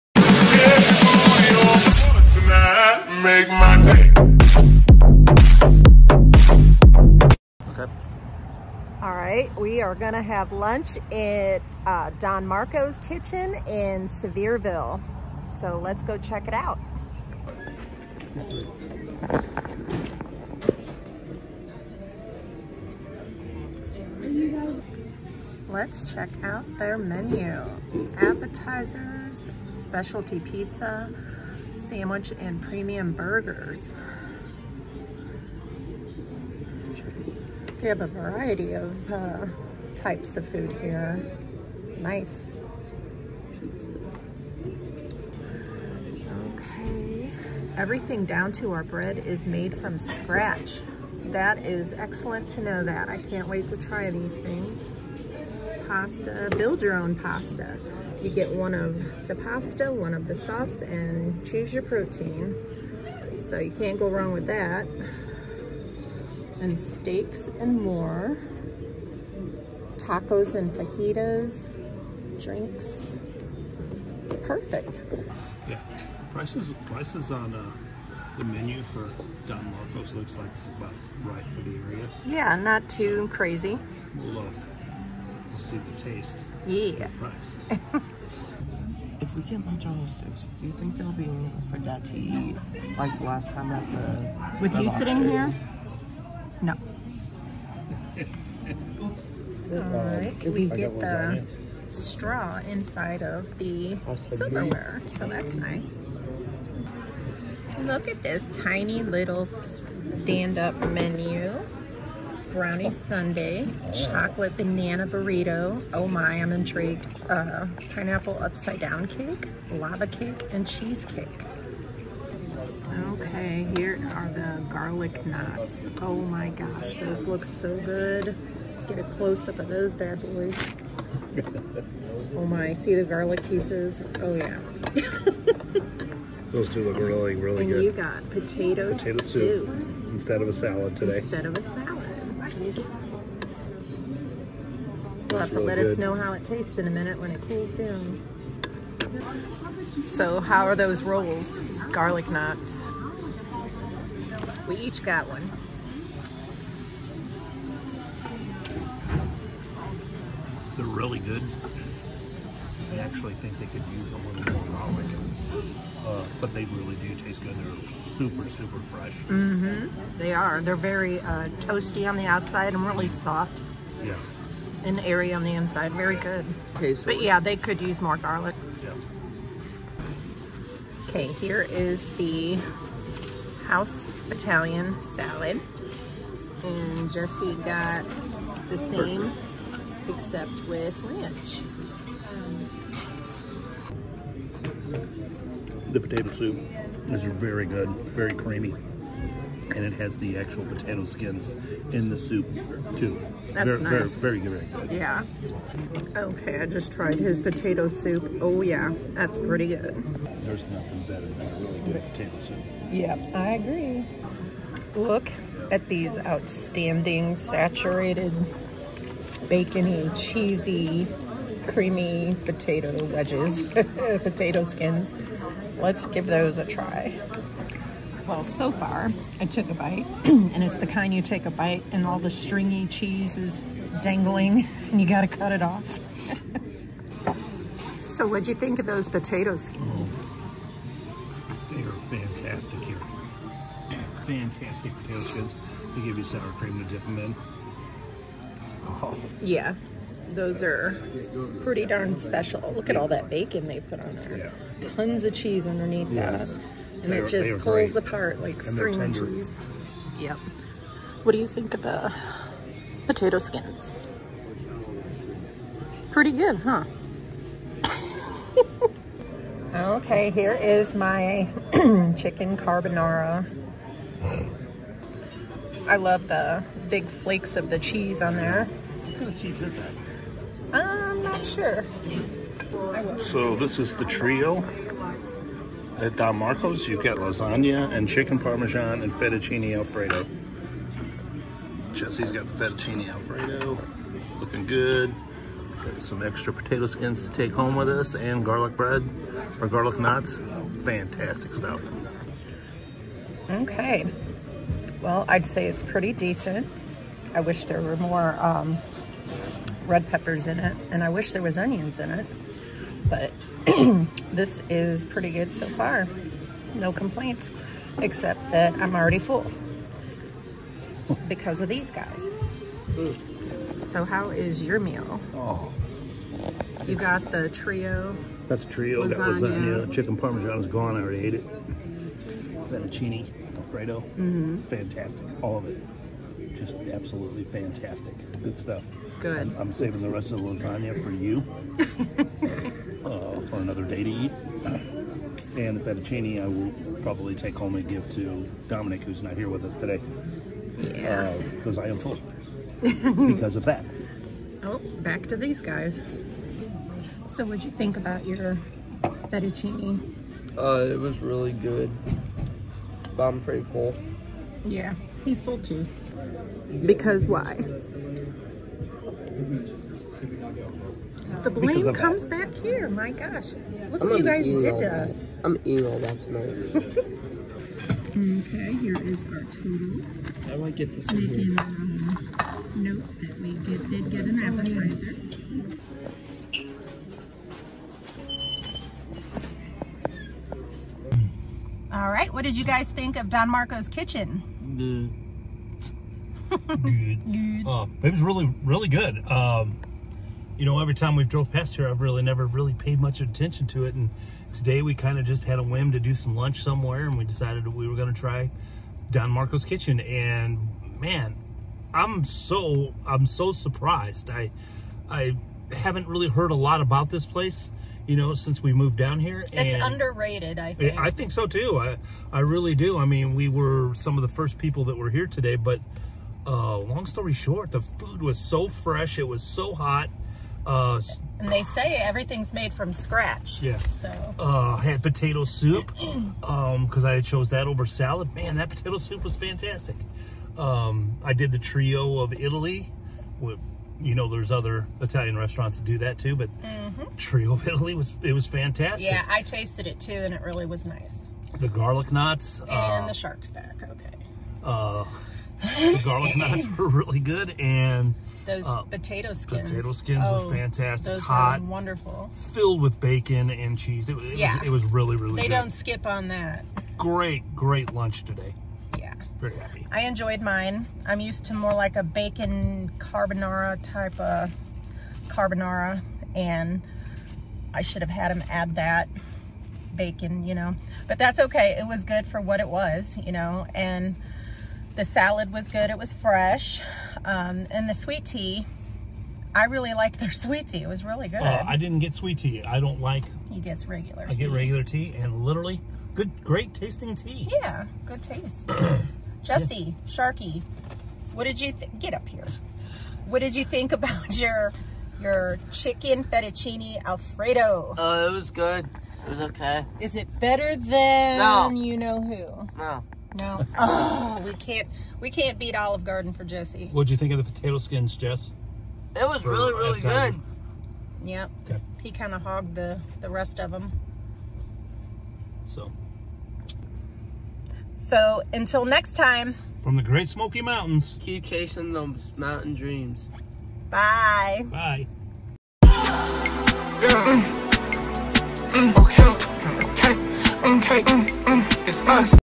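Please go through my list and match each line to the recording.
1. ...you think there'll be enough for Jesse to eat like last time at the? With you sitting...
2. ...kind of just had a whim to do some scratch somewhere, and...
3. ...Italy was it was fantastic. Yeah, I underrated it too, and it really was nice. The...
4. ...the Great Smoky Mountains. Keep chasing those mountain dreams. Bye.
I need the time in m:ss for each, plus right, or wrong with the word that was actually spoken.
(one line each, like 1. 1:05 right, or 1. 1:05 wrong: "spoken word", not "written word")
1. 1:30 wrong: "Dad", not "Jesse"
2. 6:44 wrong: "lunch", not "scratch"
3. 7:27 wrong: "tasted", not "underrated"
4. 8:49 right.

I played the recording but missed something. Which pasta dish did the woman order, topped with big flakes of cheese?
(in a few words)
Chicken carbonara.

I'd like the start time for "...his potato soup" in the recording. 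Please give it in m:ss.
3:27.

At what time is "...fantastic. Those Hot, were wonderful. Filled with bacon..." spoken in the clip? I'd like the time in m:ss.
7:40.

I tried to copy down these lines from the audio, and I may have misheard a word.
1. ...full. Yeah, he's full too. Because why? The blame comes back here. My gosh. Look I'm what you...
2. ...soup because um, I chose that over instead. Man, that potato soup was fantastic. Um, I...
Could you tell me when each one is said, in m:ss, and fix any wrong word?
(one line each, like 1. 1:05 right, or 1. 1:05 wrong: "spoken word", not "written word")
1. 6:03 right
2. 7:15 wrong: "salad", not "instead".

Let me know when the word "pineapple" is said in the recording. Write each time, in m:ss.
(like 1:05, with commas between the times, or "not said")
1:57.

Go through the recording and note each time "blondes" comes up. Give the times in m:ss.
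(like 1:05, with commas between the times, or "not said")
not said.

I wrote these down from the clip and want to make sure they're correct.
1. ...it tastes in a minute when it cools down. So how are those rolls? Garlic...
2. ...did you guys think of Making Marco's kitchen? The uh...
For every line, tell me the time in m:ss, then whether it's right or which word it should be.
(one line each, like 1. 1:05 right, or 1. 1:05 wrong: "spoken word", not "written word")
1. 2:26 right
2. 6:32 wrong: "Don", not "Making".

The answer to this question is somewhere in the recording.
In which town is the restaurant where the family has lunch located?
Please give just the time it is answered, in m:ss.
0:14.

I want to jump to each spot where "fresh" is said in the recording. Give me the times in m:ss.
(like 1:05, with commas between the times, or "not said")
2:48, 7:08, 8:06.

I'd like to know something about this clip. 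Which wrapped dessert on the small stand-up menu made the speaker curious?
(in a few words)
Chocolate banana burrito.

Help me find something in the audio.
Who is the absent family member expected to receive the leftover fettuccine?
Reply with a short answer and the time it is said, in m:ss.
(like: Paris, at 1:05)
Dominic, at 5:48.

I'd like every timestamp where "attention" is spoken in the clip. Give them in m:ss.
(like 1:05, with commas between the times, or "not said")
6:43.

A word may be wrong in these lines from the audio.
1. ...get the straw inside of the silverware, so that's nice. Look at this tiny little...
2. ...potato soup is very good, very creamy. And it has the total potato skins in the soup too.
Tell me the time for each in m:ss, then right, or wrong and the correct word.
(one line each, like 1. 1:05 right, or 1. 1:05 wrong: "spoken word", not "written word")
1. 1:40 right
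2. 3:15 wrong: "actual", not "total".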